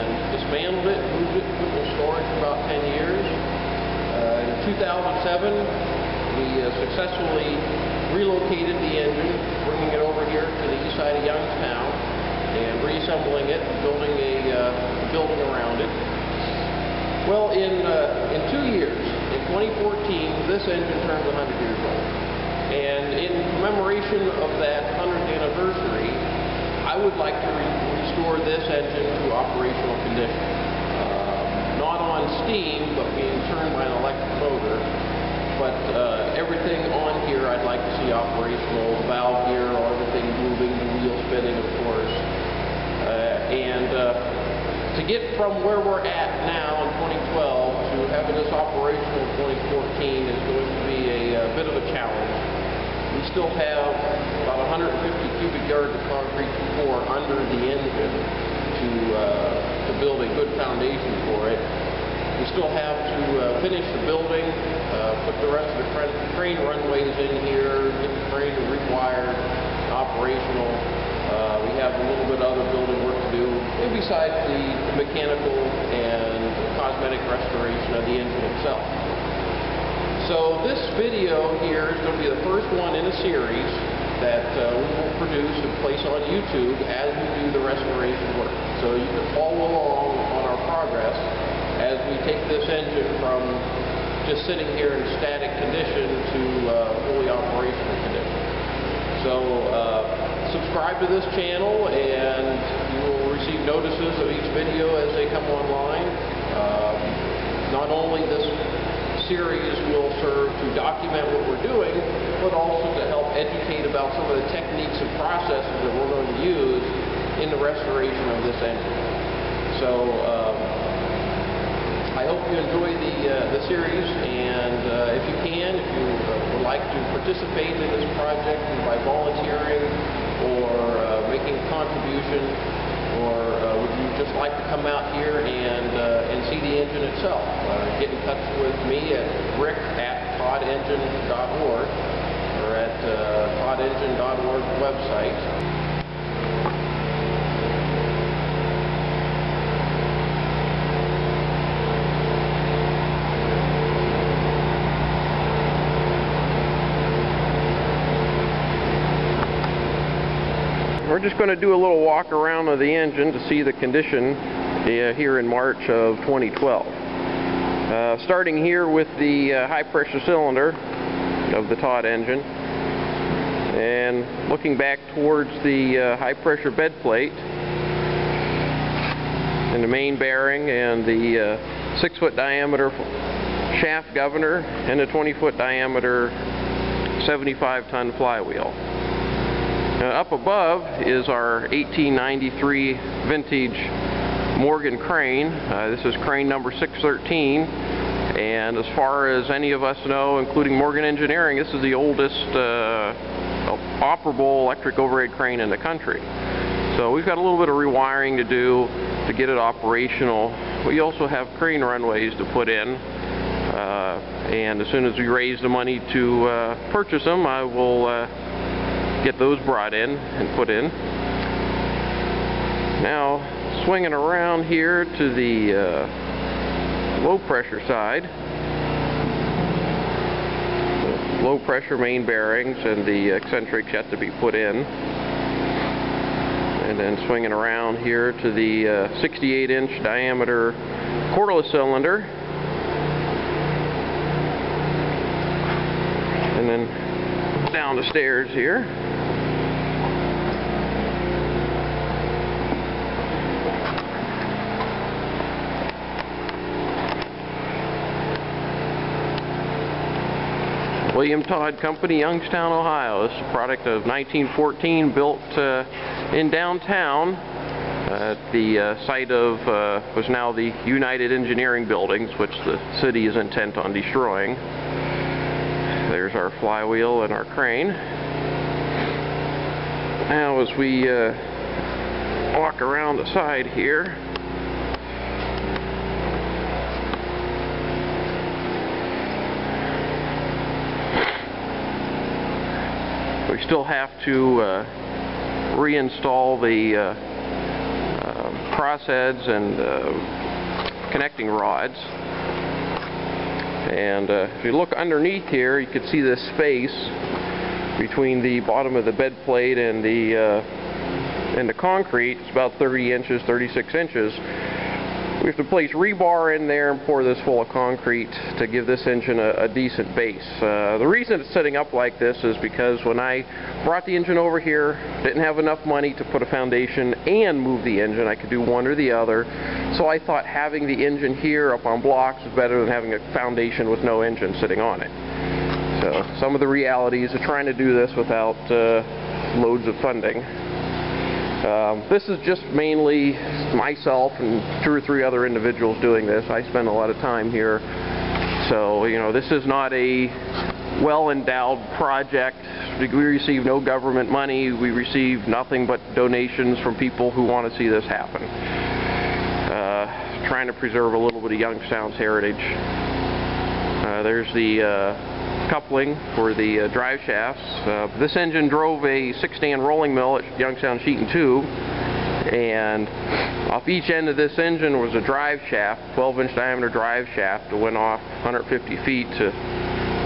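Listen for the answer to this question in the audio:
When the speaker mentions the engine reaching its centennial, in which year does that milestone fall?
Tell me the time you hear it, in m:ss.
0:18.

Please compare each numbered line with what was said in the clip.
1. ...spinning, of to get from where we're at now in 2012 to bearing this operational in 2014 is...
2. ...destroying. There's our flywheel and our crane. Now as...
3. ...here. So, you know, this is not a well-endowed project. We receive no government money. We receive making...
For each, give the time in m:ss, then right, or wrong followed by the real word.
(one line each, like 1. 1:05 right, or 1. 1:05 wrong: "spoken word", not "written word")
1. 0:41 wrong: "having", not "bearing"
2. 4:33 right
3. 5:47 wrong: "nothing", not "making".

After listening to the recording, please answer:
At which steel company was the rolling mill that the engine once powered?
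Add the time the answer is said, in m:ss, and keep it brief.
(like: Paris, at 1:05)
Youngstown Sheet and Tube, at 6:10.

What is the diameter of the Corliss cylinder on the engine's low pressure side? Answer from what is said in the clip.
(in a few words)
68 inch.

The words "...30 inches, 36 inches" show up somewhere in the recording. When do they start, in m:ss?
5:12.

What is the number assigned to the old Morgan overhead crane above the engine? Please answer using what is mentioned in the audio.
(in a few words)
613.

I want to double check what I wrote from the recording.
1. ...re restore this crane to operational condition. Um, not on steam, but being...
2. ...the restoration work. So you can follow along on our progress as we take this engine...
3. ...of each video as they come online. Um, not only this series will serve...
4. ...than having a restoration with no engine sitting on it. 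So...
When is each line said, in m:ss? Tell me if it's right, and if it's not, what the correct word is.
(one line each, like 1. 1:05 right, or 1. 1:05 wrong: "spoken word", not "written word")
1. 0:27 wrong: "engine", not "crane"
2. 1:27 right
3. 1:44 right
4. 5:32 wrong: "foundation", not "restoration".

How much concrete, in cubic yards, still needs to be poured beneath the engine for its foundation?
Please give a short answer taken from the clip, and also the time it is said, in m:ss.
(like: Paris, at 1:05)
150 cubic yards, at 0:54.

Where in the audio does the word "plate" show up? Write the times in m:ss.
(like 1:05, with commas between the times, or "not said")
2:56, 5:09.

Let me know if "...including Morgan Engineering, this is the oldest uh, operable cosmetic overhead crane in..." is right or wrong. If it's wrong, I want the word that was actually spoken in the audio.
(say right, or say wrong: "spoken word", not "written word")
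wrong: "electric", not "cosmetic".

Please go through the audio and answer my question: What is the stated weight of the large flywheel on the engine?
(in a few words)
75 ton.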